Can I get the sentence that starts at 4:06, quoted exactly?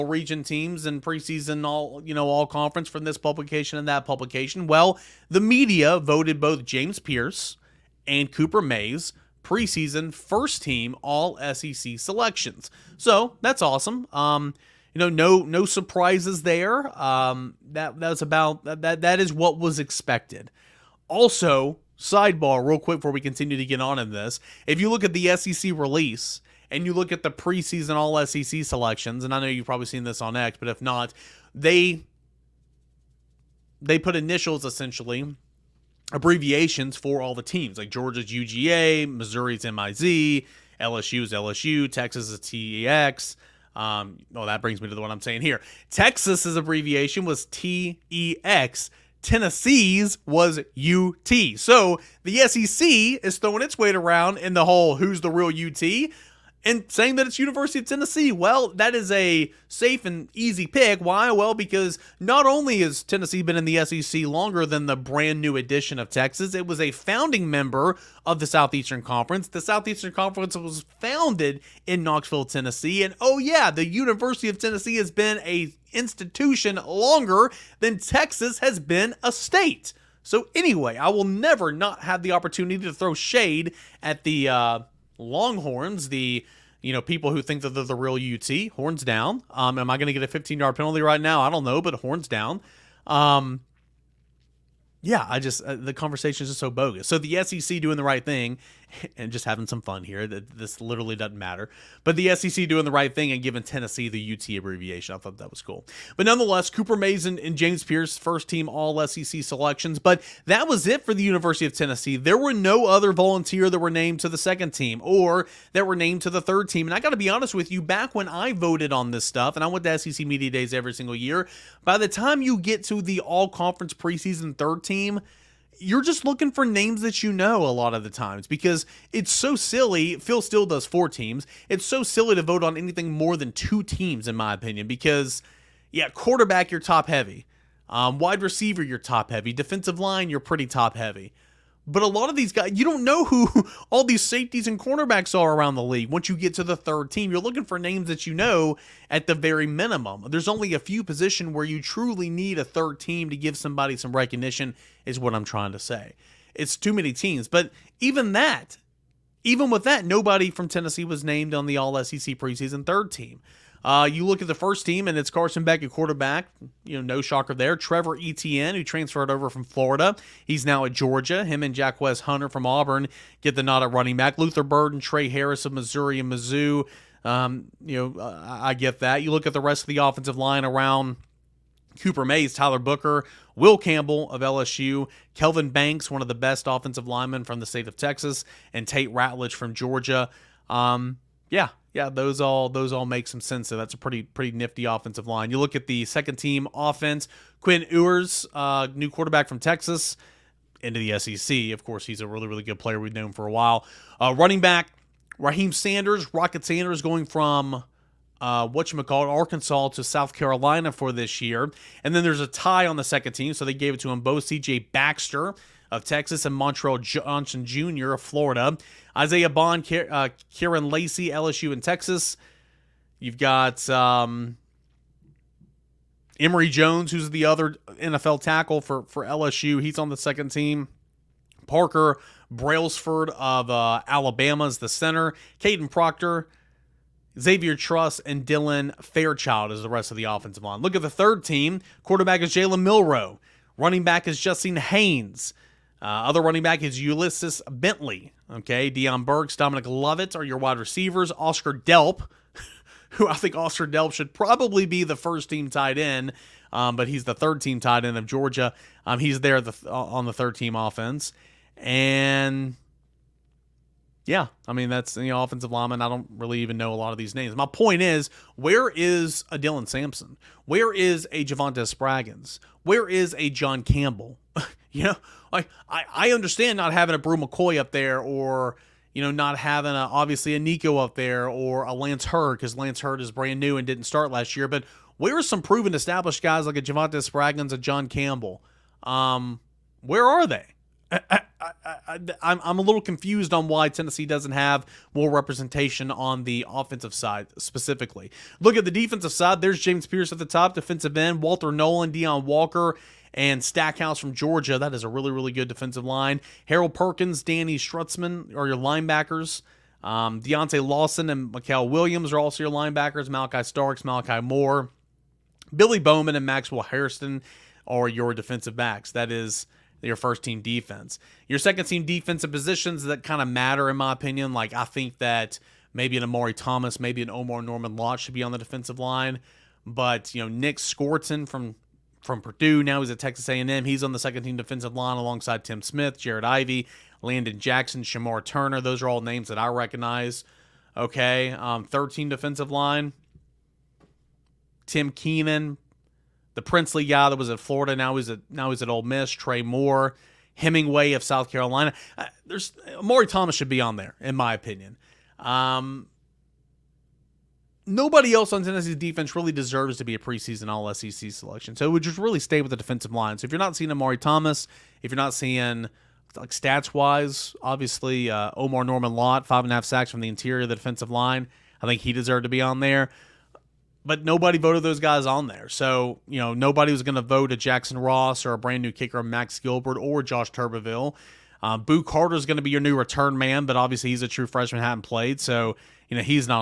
Uh, other running back is Ulysses Bentley.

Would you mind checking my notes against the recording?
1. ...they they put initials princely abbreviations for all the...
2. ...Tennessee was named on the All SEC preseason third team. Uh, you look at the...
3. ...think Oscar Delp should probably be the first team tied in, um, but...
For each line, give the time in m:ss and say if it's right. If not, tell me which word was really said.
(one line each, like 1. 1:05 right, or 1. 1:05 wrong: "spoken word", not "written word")
1. 0:31 wrong: "essentially", not "princely"
2. 2:40 right
3. 4:13 right.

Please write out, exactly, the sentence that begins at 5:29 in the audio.
But, you know, Nic Scourton from from Purdue, now he's at Texas A&M.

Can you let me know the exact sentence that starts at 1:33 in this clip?
Um, yeah, I just uh, the conversation is just so bogus.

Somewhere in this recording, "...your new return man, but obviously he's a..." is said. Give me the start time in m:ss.
6:22.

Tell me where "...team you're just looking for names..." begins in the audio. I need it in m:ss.
2:04.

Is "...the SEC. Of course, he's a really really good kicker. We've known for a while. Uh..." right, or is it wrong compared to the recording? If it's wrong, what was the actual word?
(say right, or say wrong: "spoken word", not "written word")
wrong: "player", not "kicker".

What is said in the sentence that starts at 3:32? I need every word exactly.
And then there's a tie on the second team, so they gave it to him both.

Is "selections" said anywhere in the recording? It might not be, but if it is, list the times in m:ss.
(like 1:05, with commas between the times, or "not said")
0:11, 0:28, 1:49, 6:01.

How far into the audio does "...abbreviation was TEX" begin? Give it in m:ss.
0:46.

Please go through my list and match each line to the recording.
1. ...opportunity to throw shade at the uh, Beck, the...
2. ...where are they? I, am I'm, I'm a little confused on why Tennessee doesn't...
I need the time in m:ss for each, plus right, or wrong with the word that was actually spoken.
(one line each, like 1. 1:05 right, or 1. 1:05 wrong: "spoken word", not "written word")
1. 1:22 wrong: "Longhorns", not "Beck"
2. 4:50 right.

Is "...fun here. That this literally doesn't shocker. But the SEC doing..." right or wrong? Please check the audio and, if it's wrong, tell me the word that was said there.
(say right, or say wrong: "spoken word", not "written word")
wrong: "matter", not "shocker".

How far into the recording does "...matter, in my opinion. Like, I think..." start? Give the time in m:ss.
5:23.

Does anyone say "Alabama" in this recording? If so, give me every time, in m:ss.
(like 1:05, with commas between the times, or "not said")
3:54.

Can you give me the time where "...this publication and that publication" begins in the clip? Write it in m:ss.
0:03.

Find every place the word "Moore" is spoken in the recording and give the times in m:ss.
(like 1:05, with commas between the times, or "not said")
5:14, 5:49.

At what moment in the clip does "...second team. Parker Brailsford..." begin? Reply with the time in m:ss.
3:50.